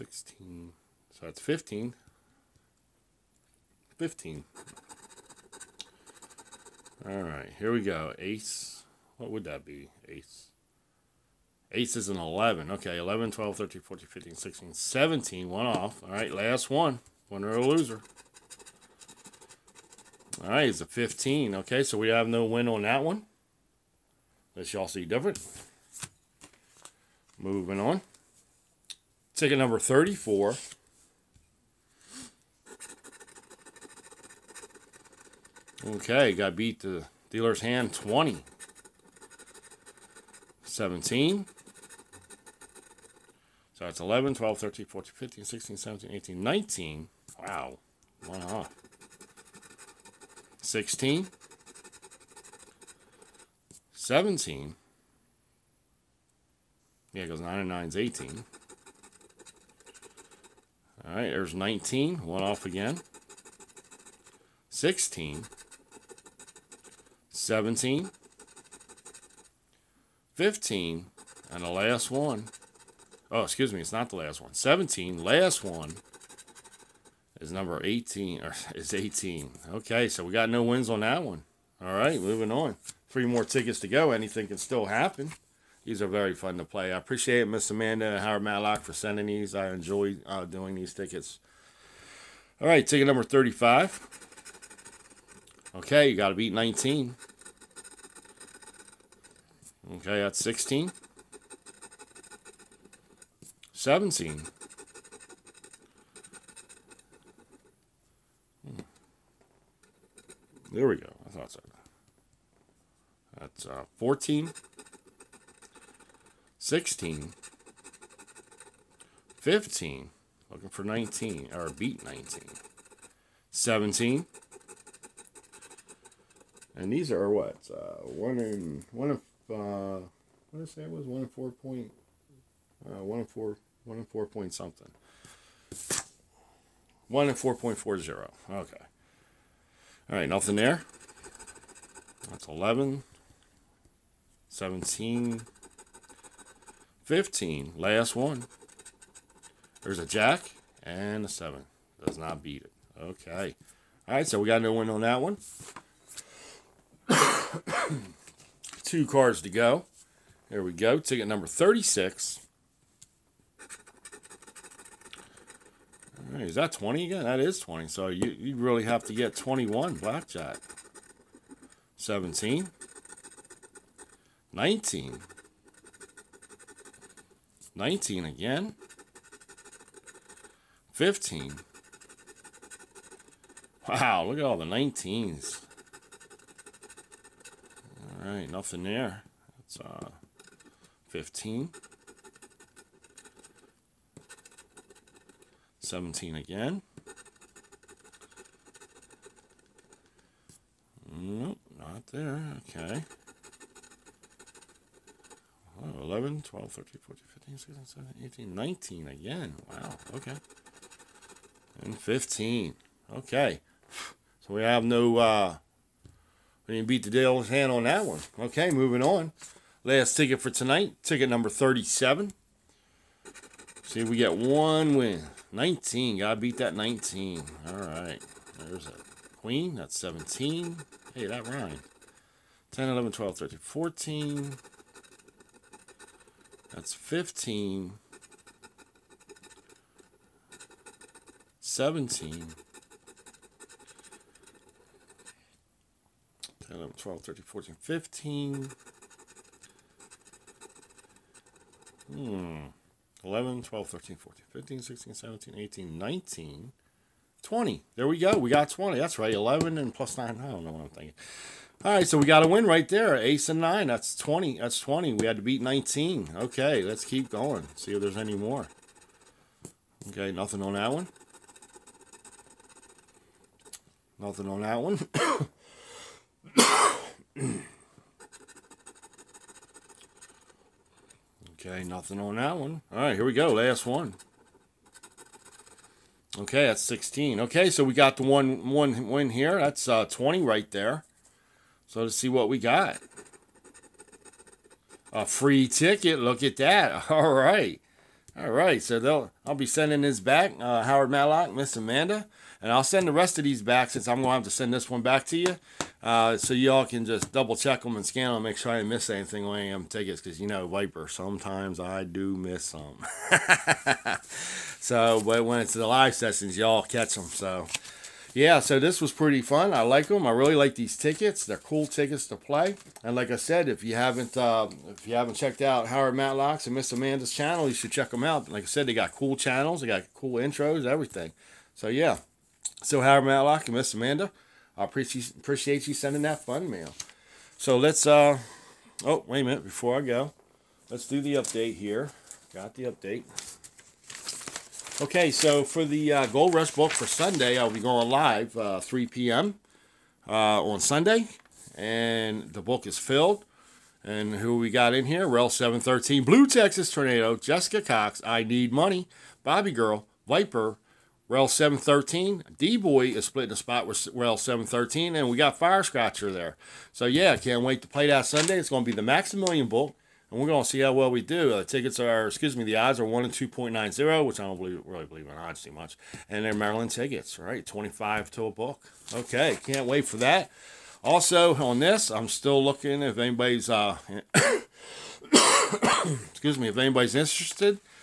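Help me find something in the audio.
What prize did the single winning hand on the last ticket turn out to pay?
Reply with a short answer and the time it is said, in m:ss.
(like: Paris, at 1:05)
A free ticket, at 4:55.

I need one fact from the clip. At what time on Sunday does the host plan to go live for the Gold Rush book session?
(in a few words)
3 p.m.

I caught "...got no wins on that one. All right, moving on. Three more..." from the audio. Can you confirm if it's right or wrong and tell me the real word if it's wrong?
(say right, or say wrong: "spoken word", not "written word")
right.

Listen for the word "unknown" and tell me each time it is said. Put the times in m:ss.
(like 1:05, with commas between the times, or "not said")
not said.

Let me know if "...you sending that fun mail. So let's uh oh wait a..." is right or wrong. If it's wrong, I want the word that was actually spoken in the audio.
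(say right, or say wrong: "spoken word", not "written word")
right.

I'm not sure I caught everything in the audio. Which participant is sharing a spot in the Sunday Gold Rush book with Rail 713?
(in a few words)
D Boy.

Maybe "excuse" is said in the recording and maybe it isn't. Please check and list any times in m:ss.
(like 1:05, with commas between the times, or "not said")
1:13, 6:12, 6:26.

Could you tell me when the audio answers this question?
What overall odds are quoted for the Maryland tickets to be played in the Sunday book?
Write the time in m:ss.
6:13.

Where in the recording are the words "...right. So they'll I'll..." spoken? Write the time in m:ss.
4:58.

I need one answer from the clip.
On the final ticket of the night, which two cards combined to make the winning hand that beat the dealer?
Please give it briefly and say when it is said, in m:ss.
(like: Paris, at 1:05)
Ace and 9, at 4:23.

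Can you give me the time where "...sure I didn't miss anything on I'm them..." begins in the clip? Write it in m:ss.
5:08.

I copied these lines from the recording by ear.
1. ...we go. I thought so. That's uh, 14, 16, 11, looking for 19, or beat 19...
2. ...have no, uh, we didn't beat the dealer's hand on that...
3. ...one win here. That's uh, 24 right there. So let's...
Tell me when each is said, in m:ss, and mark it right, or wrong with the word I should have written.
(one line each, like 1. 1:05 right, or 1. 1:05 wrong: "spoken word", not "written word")
1. 1:50 wrong: "15", not "11"
2. 3:34 right
3. 4:48 wrong: "20", not "24".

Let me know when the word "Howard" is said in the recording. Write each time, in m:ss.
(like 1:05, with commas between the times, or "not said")
1:28, 5:00, 5:25, 5:33.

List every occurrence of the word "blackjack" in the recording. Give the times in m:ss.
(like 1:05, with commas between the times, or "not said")
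2:49.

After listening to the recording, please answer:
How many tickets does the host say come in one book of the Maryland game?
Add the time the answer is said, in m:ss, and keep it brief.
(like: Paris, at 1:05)
25, at 6:17.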